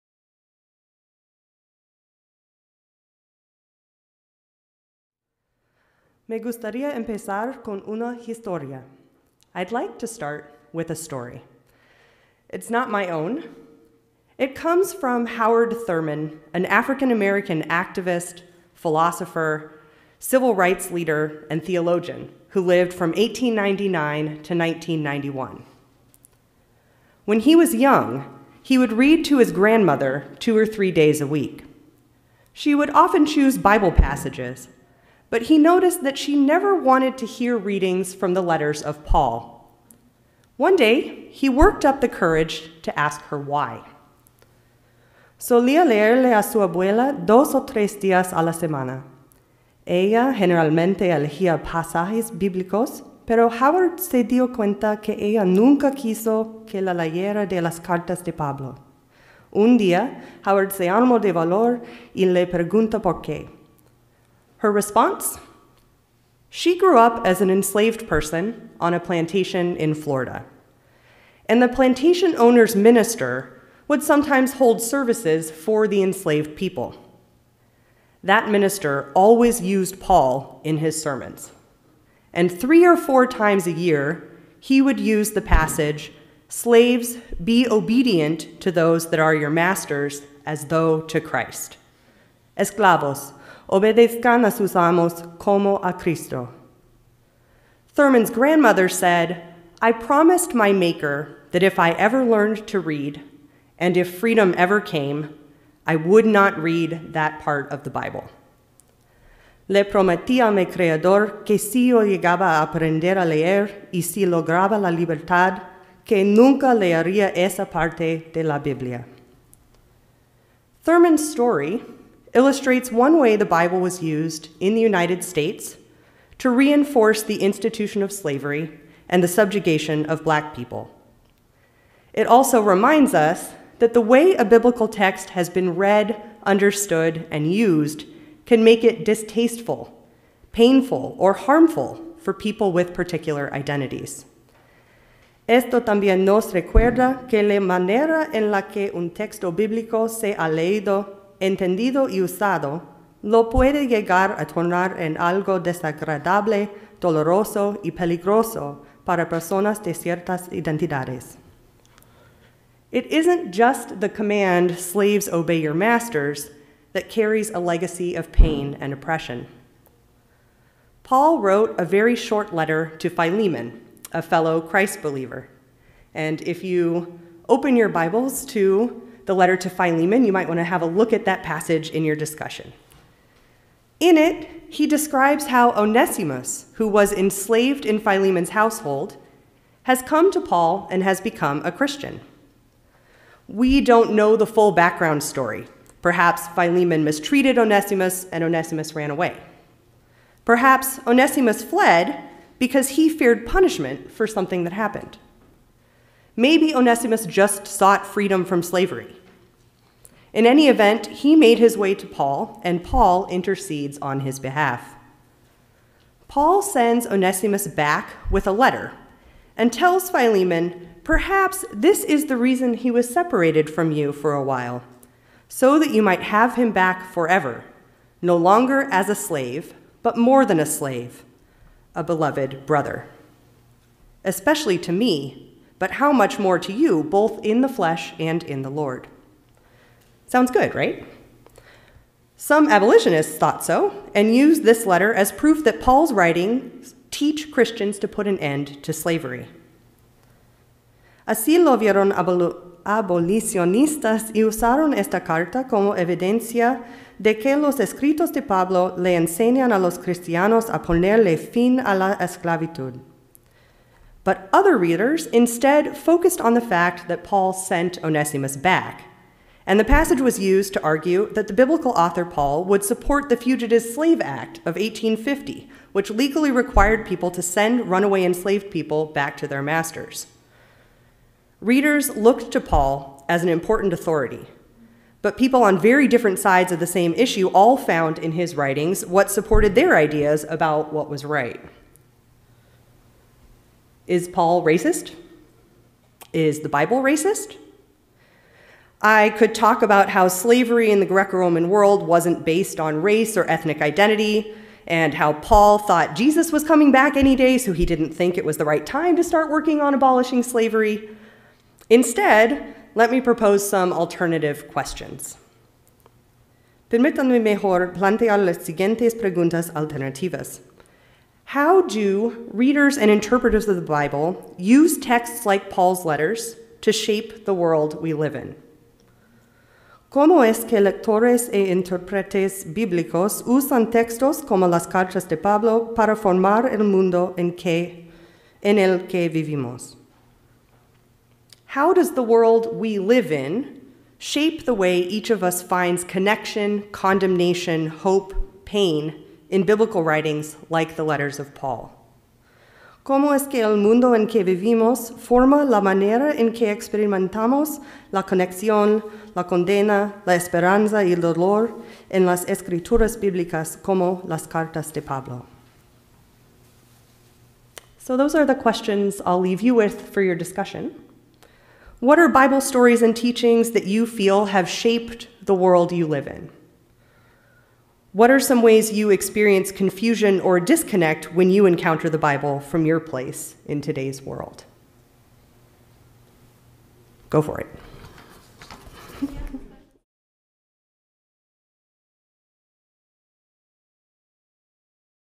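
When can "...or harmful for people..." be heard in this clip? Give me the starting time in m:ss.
2:21.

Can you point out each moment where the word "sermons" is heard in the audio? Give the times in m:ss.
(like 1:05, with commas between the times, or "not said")
1:21.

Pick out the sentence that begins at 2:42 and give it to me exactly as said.
It isn't just the command, slaves obey your masters, that carries a legacy of pain and oppression.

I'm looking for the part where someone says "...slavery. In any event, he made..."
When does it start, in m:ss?
3:28.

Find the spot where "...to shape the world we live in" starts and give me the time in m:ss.
5:26.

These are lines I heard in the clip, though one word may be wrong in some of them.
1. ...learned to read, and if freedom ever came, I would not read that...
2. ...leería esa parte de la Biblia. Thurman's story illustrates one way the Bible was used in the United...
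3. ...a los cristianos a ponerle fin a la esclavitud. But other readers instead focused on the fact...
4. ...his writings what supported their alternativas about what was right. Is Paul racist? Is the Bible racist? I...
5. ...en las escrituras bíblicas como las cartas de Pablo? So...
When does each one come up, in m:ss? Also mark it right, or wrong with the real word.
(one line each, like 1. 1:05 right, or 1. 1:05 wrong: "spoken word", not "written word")
1. 1:42 right
2. 1:56 right
3. 4:19 right
4. 4:48 wrong: "ideas", not "alternativas"
5. 6:02 right.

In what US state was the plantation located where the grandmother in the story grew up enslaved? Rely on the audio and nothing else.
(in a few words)
Florida.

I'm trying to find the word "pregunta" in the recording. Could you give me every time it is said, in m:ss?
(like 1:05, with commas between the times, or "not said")
1:02, 5:19.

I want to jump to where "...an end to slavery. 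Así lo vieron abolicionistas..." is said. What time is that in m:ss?
4:08.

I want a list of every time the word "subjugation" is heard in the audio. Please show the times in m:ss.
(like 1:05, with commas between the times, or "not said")
2:09.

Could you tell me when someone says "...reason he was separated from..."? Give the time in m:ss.
3:42.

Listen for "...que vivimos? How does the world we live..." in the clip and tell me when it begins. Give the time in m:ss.
5:39.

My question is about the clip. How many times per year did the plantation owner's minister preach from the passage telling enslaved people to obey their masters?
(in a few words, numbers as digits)
3 or 4.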